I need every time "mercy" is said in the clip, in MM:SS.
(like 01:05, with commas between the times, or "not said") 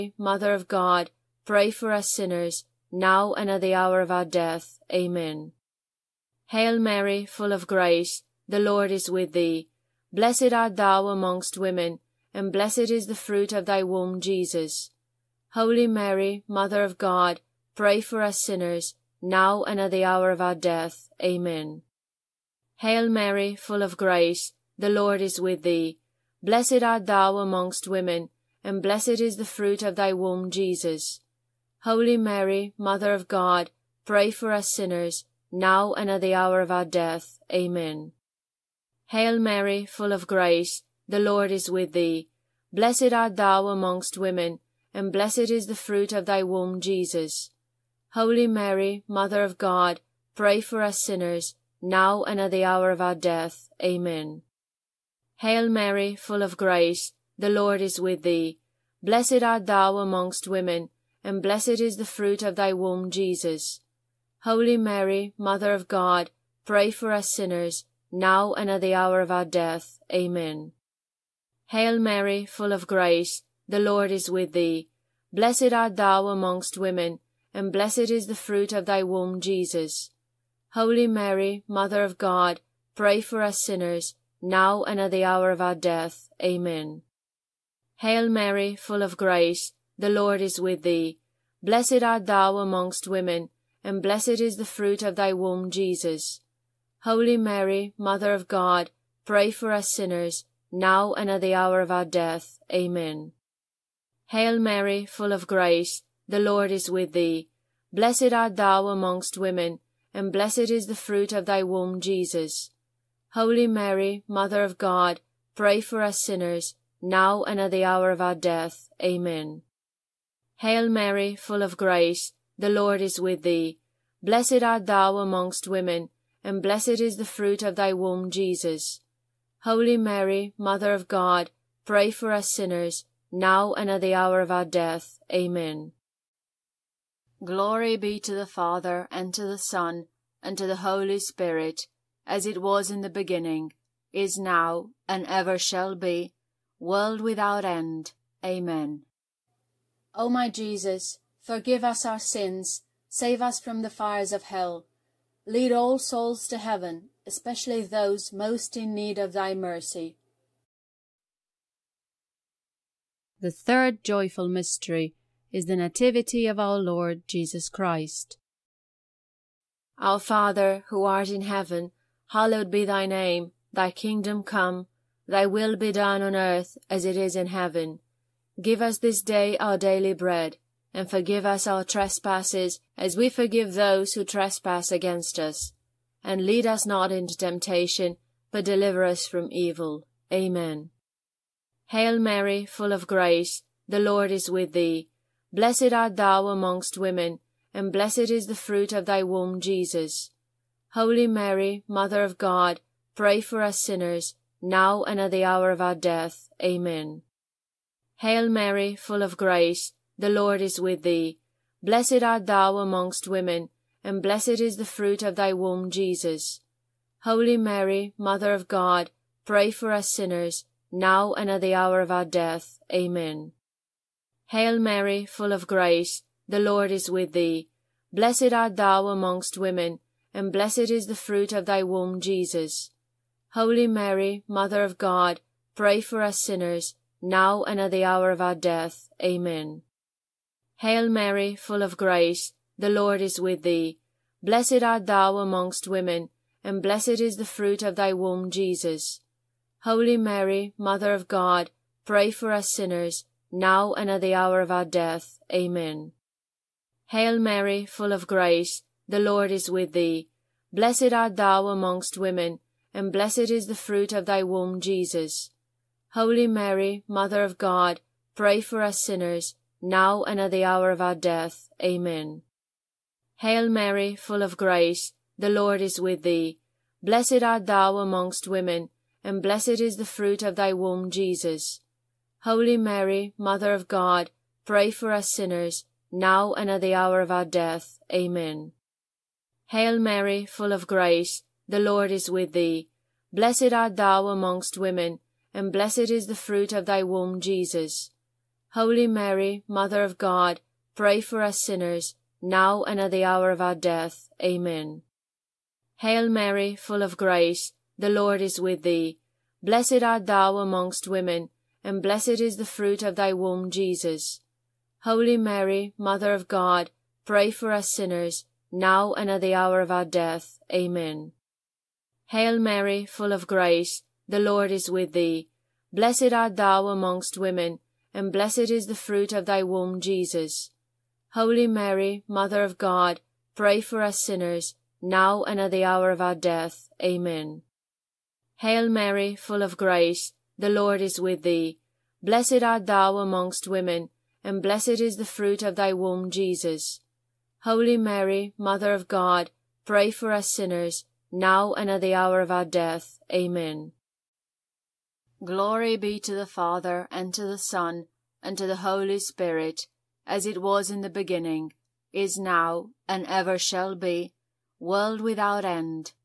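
02:39.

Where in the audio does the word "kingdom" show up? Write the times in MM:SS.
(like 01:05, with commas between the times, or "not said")
02:53.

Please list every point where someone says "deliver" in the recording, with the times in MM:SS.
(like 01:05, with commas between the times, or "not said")
03:08.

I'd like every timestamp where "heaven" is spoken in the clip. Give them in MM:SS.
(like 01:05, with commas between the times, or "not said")
02:36, 02:51, 02:57.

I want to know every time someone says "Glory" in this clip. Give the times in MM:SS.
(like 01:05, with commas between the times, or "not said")
02:17, 05:55.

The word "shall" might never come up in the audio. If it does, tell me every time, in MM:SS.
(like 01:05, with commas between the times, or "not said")
02:25, 06:03.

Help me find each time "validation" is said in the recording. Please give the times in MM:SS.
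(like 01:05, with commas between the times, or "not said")
not said.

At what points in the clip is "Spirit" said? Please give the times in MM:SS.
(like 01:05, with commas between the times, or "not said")
02:21, 05:59.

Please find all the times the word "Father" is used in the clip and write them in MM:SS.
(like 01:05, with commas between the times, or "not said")
02:18, 02:50, 05:56.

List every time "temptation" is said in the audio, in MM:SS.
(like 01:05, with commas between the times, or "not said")
03:07.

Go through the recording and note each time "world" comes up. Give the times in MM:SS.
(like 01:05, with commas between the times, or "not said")
02:26, 06:04.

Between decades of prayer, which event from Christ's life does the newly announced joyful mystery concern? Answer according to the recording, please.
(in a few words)
The Nativity.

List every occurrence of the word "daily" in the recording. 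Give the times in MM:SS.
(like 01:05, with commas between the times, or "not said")
02:59.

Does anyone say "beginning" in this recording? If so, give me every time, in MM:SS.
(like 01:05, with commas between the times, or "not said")
02:23, 06:01.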